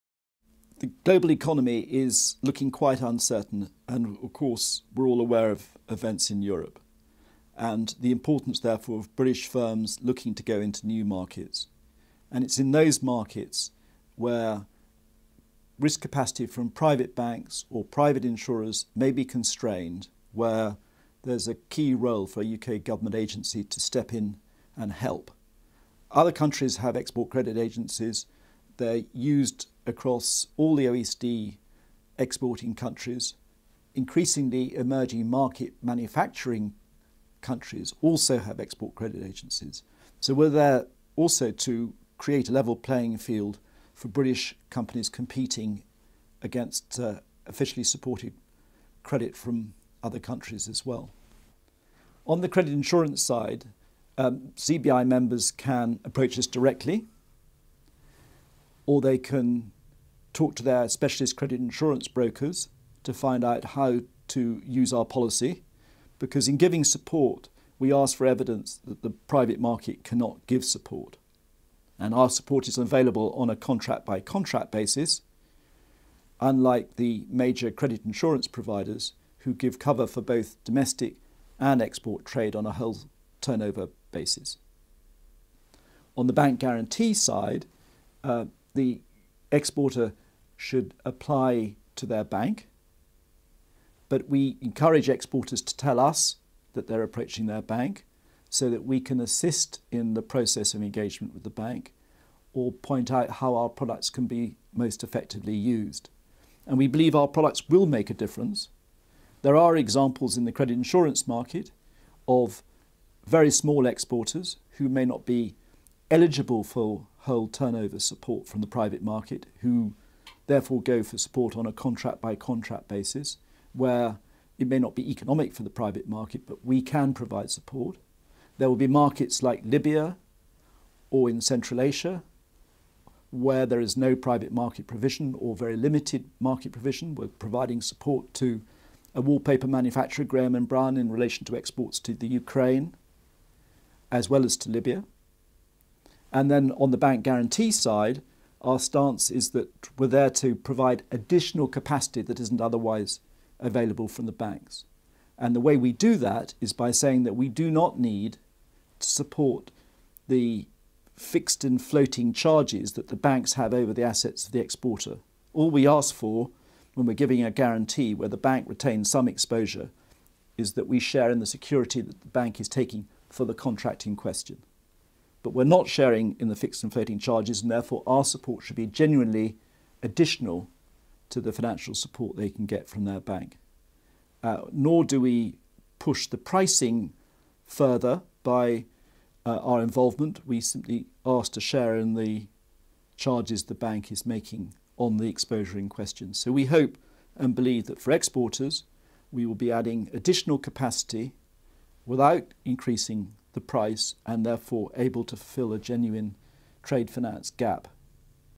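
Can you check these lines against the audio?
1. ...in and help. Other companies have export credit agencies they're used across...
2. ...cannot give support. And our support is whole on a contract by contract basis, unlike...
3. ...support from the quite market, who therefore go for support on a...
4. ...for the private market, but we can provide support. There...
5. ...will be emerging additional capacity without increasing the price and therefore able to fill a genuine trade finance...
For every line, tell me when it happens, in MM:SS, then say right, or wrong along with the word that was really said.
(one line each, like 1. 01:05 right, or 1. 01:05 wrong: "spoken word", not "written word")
1. 00:24 wrong: "countries", not "companies"
2. 01:10 wrong: "available", not "whole"
3. 01:57 wrong: "private", not "quite"
4. 02:05 right
5. 03:19 wrong: "adding", not "emerging".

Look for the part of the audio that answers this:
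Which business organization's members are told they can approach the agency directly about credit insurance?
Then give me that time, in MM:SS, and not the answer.
00:54.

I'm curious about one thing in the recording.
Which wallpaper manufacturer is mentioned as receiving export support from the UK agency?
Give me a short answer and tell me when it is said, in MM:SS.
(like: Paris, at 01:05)
Graham and Brown, at 02:20.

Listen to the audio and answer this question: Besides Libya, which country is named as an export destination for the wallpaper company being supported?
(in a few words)
Ukraine.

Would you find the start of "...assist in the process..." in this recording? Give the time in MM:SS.
01:39.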